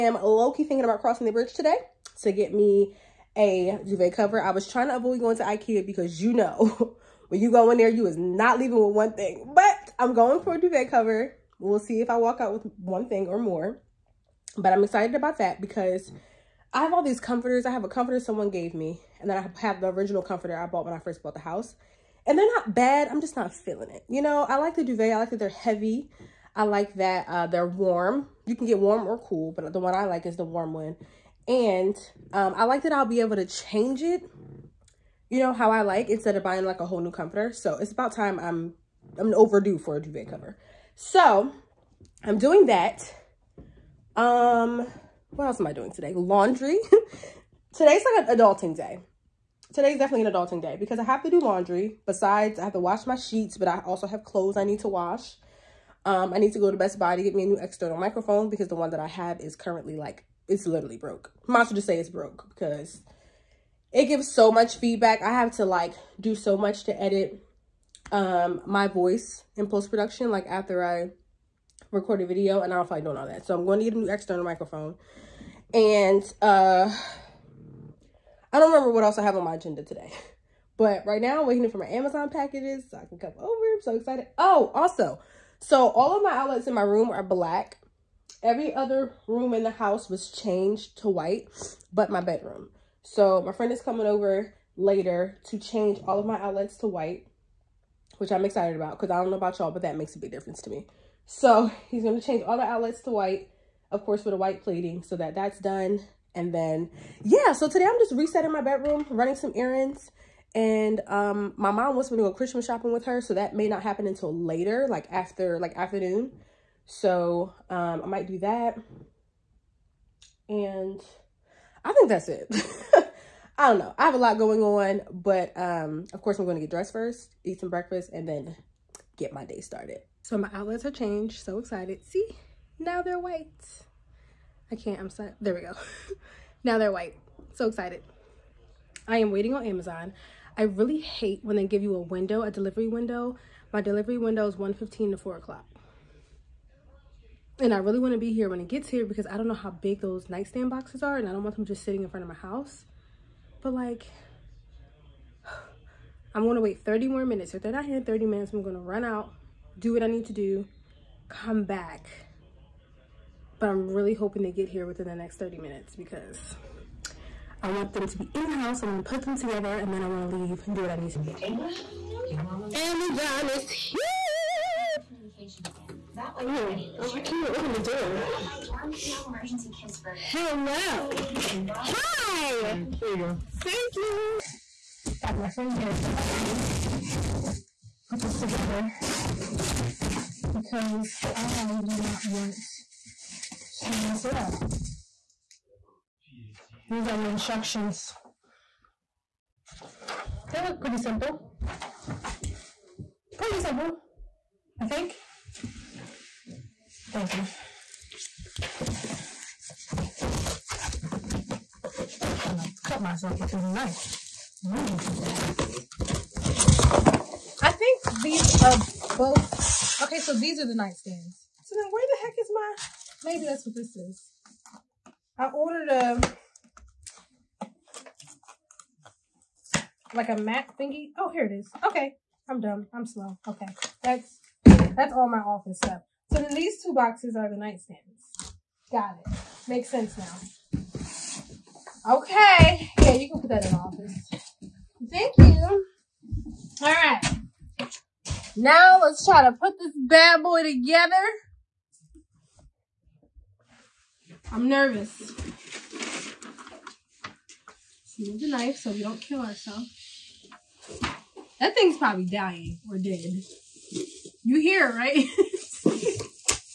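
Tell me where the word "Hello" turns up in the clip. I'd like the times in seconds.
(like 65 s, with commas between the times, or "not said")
180 s.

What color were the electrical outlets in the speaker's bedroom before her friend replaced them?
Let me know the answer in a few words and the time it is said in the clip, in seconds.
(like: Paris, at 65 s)
black, at 87 s.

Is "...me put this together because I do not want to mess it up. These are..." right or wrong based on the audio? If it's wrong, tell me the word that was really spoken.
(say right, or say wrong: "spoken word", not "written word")
right.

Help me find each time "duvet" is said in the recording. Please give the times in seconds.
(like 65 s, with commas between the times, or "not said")
3 s, 10 s, 24 s, 40 s.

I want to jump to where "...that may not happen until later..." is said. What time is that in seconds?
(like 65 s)
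113 s.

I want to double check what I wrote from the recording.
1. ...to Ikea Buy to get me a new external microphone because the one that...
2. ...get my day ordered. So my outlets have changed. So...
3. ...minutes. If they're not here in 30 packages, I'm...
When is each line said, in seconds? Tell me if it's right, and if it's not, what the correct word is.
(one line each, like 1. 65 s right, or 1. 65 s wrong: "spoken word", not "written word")
1. 56 s wrong: "Best", not "Ikea"
2. 129 s wrong: "started", not "ordered"
3. 157 s wrong: "minutes", not "packages".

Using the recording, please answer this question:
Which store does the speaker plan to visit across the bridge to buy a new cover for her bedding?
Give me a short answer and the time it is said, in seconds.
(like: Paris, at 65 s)
Ikea, at 5 s.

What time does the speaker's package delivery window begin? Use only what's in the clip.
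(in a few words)
1:15.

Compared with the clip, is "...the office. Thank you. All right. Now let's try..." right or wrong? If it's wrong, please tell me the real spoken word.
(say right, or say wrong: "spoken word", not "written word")
right.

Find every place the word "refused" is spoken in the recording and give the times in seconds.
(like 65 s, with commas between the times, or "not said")
not said.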